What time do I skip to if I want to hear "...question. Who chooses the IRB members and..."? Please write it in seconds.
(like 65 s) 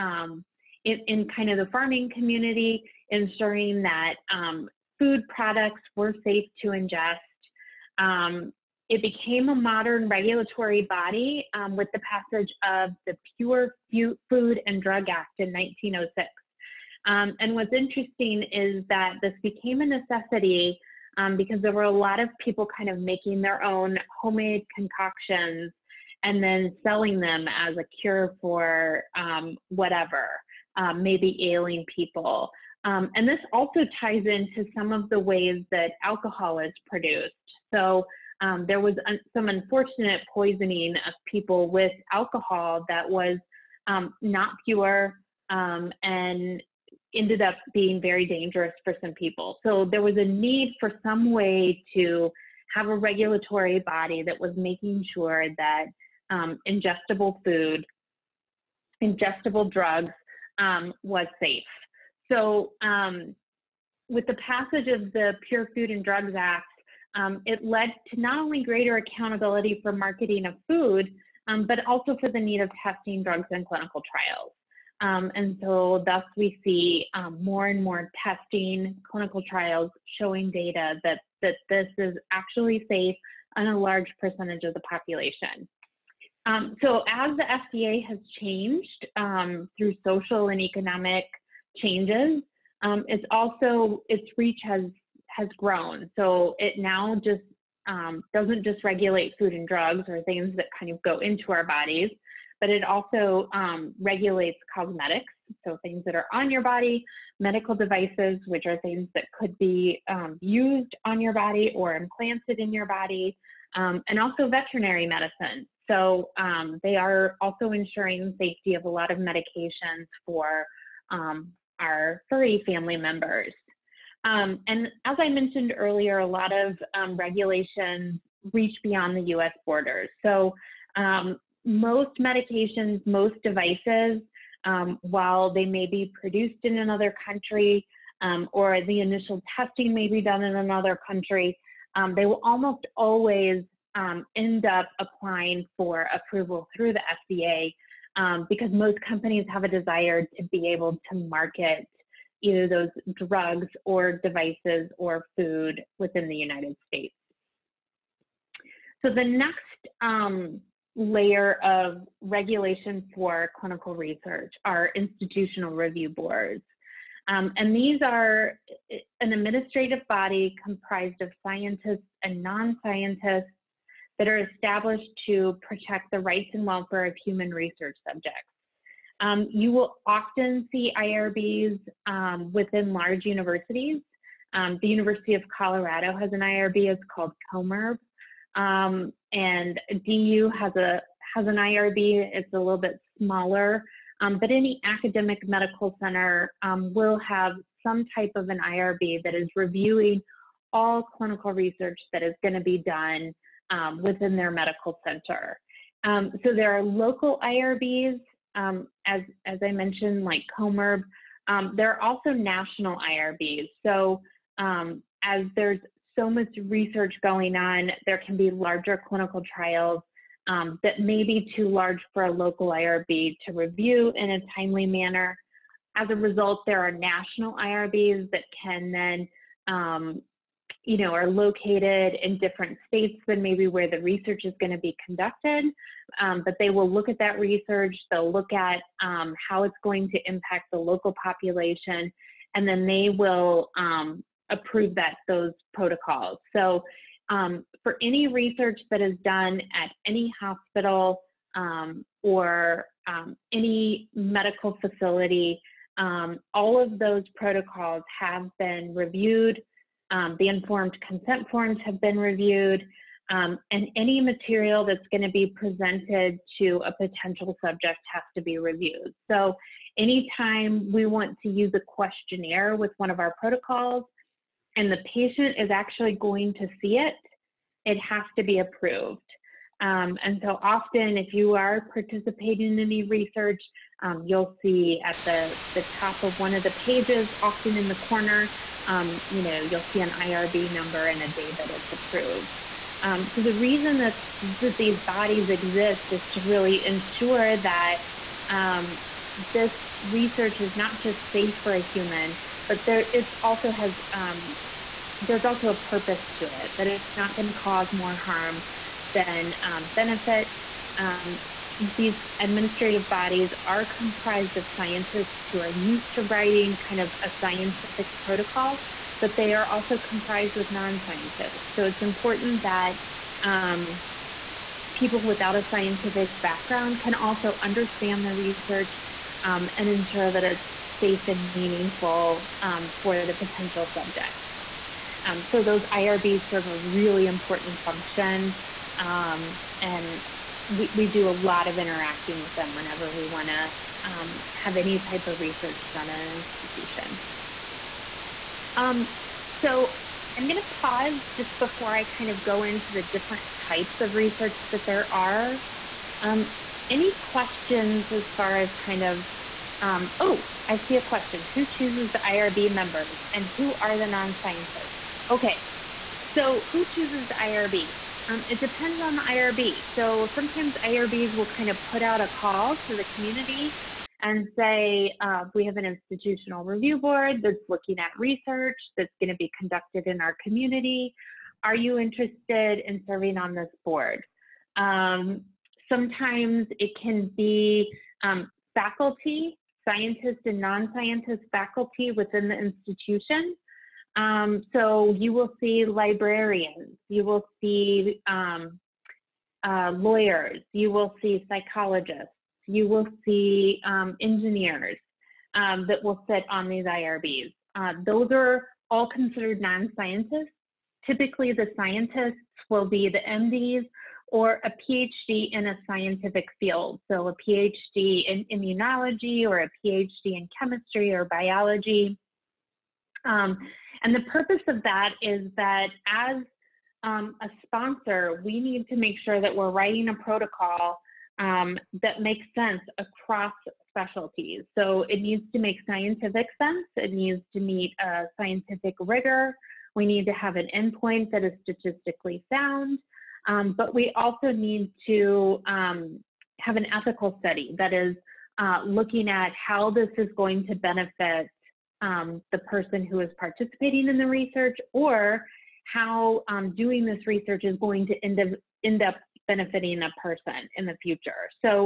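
361 s.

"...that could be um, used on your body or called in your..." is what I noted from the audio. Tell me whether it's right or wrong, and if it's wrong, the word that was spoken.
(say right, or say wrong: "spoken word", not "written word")
wrong: "implanted", not "called".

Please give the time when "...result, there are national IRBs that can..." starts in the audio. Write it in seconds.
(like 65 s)
226 s.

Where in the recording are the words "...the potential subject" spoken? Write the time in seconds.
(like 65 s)
333 s.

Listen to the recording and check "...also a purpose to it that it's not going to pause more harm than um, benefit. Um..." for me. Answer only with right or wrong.
wrong.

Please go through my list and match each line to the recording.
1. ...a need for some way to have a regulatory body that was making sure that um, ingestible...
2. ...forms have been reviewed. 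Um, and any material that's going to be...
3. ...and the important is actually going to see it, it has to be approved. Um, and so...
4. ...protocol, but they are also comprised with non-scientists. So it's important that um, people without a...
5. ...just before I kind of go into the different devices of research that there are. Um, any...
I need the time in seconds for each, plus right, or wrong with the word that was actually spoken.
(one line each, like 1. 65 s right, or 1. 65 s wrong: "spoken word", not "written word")
1. 50 s right
2. 261 s right
3. 274 s wrong: "patient", not "important"
4. 318 s right
5. 351 s wrong: "types", not "devices".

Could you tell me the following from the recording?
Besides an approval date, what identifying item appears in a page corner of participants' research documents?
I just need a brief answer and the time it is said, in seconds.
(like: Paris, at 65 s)
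an IRB number, at 290 s.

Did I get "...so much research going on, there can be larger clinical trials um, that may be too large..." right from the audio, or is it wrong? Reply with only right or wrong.
right.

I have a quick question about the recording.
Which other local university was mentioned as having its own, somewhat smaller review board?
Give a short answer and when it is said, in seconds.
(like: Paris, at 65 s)
DU, at 190 s.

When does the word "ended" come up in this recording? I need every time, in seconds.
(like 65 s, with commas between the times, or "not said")
47 s.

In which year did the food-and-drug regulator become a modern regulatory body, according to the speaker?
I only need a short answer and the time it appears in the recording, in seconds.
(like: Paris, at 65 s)
1906, at 15 s.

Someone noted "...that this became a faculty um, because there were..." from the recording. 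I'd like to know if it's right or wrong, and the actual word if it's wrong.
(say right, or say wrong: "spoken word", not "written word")
wrong: "necessity", not "faculty".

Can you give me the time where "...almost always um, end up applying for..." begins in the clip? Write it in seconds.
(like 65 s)
142 s.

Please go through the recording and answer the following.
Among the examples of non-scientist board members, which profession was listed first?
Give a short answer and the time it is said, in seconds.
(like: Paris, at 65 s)
librarians, at 395 s.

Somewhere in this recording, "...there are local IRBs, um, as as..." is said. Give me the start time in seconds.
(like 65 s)
206 s.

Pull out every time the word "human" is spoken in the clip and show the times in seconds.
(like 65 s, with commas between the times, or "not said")
177 s, 301 s.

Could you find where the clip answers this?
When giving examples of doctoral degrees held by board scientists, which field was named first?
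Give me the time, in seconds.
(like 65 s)
418 s.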